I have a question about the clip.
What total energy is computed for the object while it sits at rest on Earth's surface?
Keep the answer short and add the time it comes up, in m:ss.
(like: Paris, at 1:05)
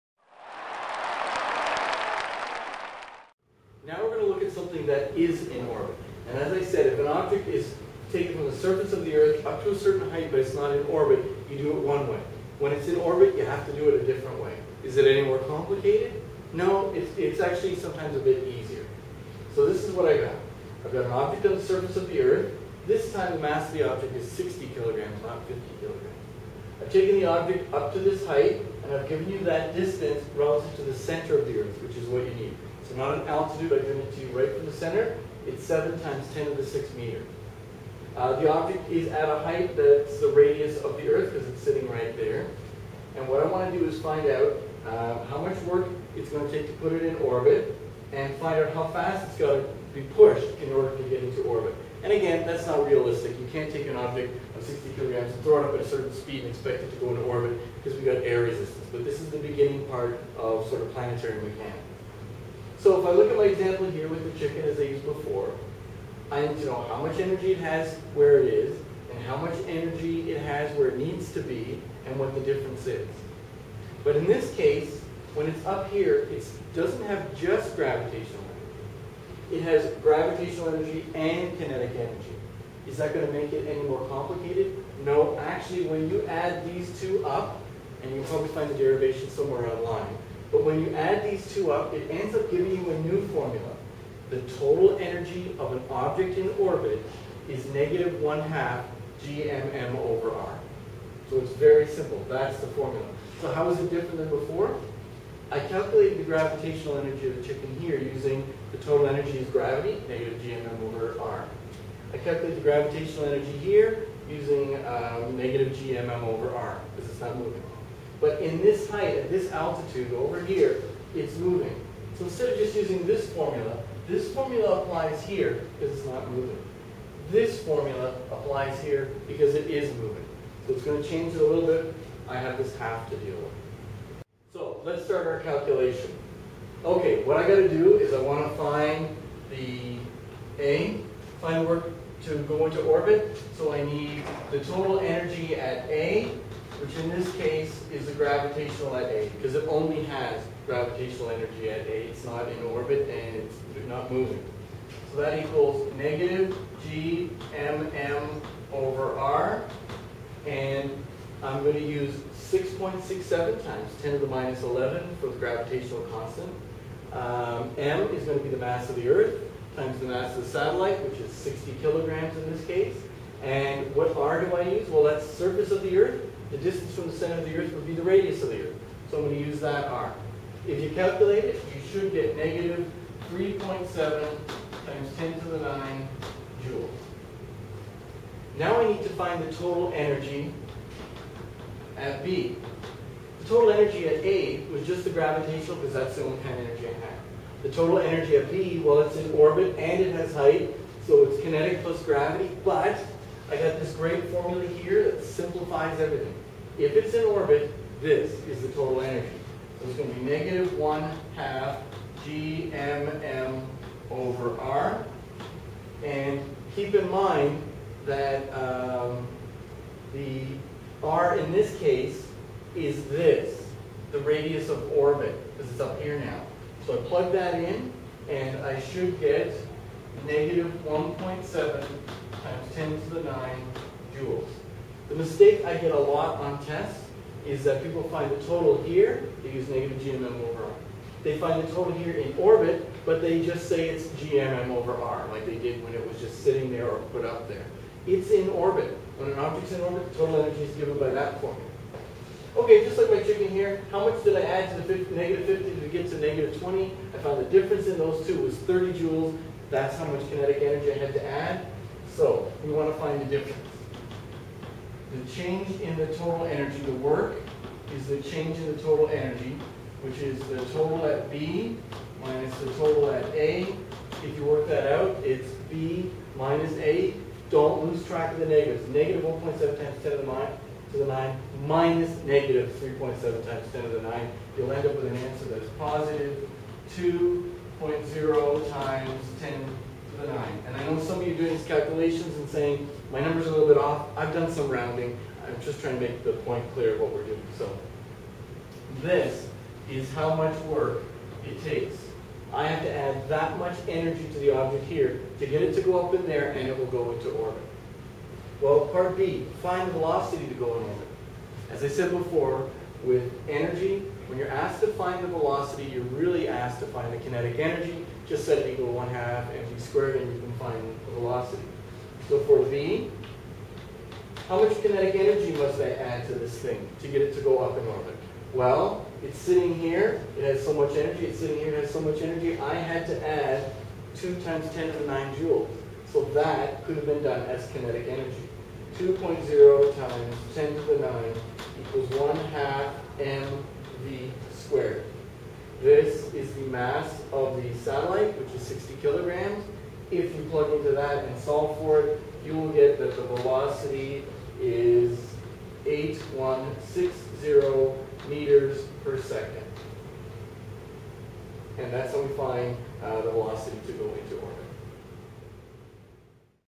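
-3.7 x 10^9 joules, at 3:02.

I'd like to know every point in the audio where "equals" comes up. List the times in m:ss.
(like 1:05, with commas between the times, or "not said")
2:35, 5:18, 5:41.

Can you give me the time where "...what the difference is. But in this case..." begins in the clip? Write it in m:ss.
1:12.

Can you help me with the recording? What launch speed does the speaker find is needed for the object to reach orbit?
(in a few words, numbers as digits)
8160 m/s.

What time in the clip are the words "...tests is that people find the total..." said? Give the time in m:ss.
3:56.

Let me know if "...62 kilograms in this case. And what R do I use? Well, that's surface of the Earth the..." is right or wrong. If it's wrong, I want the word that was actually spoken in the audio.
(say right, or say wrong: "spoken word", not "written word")
wrong: "60", not "62".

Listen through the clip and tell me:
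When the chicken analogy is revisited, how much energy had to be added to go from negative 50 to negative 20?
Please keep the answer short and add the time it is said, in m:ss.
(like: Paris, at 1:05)
30 joules, at 4:18.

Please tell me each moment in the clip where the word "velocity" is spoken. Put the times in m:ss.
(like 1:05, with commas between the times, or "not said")
5:09, 5:15, 5:21, 5:53, 6:03.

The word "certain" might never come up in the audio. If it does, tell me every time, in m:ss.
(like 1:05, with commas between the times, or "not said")
0:09, 0:55.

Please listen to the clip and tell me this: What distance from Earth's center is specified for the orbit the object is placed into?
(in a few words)
7 x 10^6 meters.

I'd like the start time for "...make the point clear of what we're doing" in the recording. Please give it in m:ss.
4:56.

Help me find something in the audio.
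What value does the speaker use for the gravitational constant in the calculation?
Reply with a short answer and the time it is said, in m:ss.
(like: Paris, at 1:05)
6.67 x 10^-11, at 2:42.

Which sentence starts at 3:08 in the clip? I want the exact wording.
Now I need to find the total energy at B.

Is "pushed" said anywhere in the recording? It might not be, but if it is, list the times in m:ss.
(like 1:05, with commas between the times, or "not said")
0:50.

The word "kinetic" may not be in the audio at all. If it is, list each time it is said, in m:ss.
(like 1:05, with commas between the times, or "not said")
1:21, 3:21, 4:20, 5:17, 5:24, 5:37.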